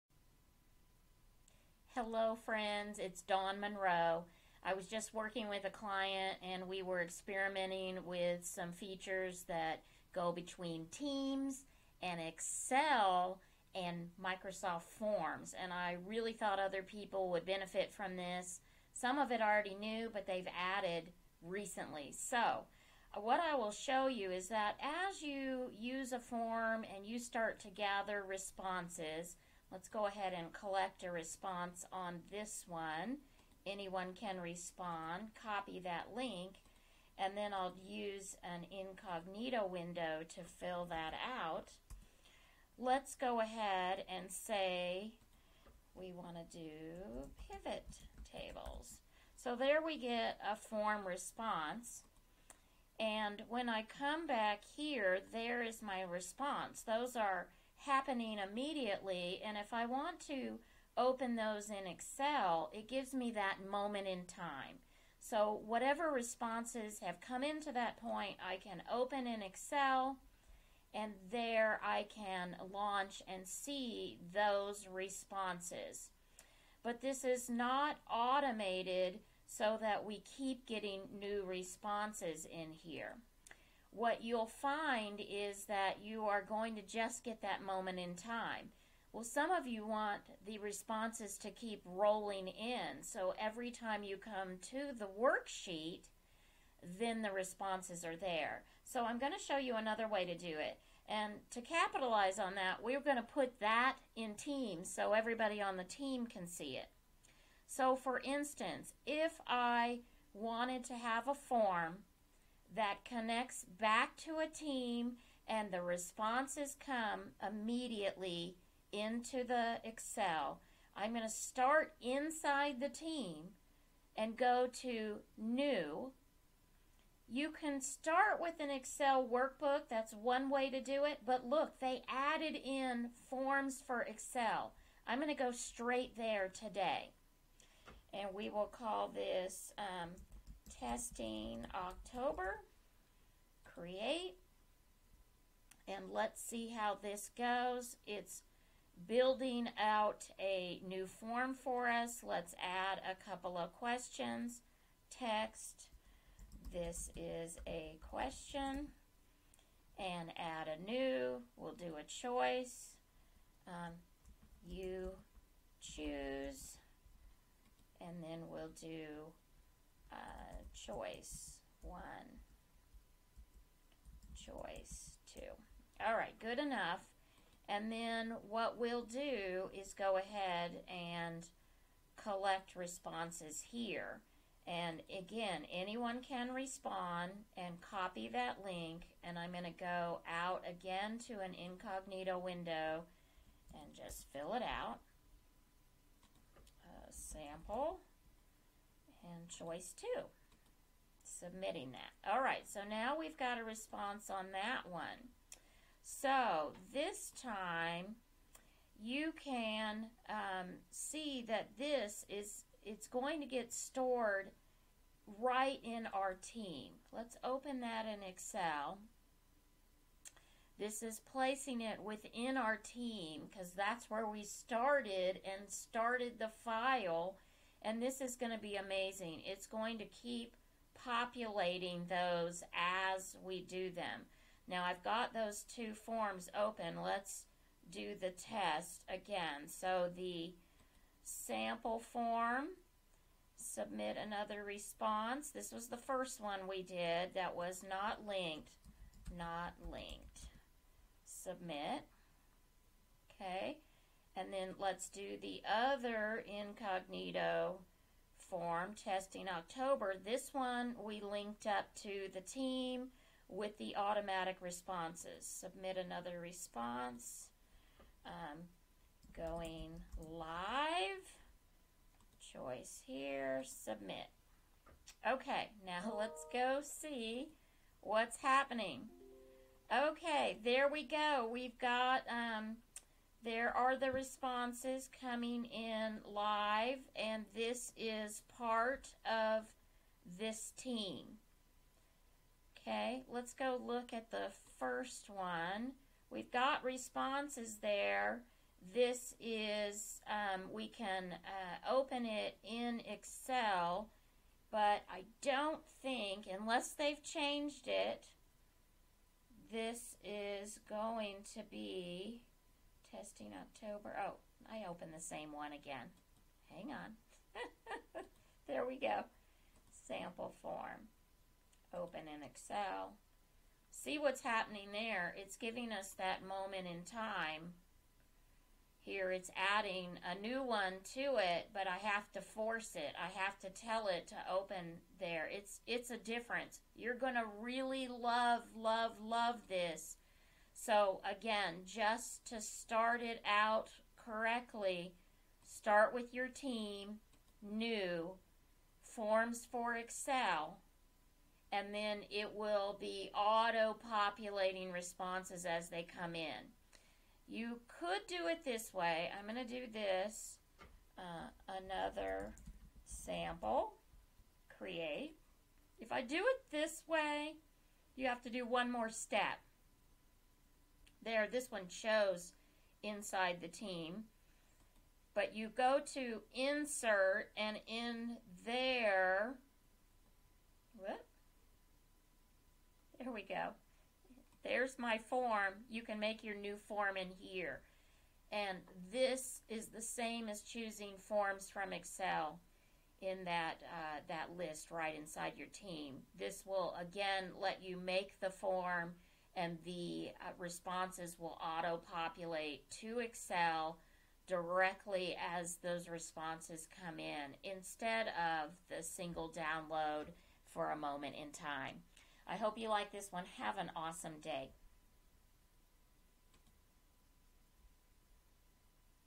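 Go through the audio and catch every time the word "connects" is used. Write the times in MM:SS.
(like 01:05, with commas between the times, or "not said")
01:53.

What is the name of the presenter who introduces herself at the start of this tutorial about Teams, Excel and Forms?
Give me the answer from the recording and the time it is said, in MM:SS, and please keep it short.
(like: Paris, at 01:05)
Dawn Monroe, at 00:03.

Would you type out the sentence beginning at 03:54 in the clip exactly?
Now I've got those two forms open.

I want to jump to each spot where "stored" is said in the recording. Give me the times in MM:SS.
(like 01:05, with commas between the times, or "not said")
03:33.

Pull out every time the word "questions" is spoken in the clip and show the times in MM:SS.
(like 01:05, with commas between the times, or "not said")
02:33, 02:38.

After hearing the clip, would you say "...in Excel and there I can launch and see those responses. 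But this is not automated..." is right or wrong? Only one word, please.
right.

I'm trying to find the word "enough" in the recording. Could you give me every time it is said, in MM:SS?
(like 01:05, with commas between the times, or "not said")
02:56.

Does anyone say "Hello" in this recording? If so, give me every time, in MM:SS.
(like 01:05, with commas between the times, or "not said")
00:01.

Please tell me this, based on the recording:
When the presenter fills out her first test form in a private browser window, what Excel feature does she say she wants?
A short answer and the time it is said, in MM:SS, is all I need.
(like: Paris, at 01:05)
pivot tables, at 00:47.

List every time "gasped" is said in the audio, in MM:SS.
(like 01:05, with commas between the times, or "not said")
not said.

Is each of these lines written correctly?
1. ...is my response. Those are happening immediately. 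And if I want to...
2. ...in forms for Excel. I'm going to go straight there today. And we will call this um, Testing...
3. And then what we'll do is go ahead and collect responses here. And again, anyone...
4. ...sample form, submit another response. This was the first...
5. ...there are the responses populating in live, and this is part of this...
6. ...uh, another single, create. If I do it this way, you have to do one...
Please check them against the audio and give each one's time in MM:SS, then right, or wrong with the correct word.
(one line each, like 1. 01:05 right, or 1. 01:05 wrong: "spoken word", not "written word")
1. 00:55 right
2. 02:12 right
3. 02:57 right
4. 04:01 right
5. 04:43 wrong: "coming", not "populating"
6. 06:01 wrong: "sample", not "single".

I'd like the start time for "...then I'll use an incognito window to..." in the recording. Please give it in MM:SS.
00:37.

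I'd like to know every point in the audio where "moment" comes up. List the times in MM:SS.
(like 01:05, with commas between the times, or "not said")
01:03, 01:27, 05:26, 06:50.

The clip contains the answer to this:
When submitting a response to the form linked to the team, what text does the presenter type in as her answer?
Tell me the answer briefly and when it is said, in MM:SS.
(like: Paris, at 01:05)
going live, at 04:29.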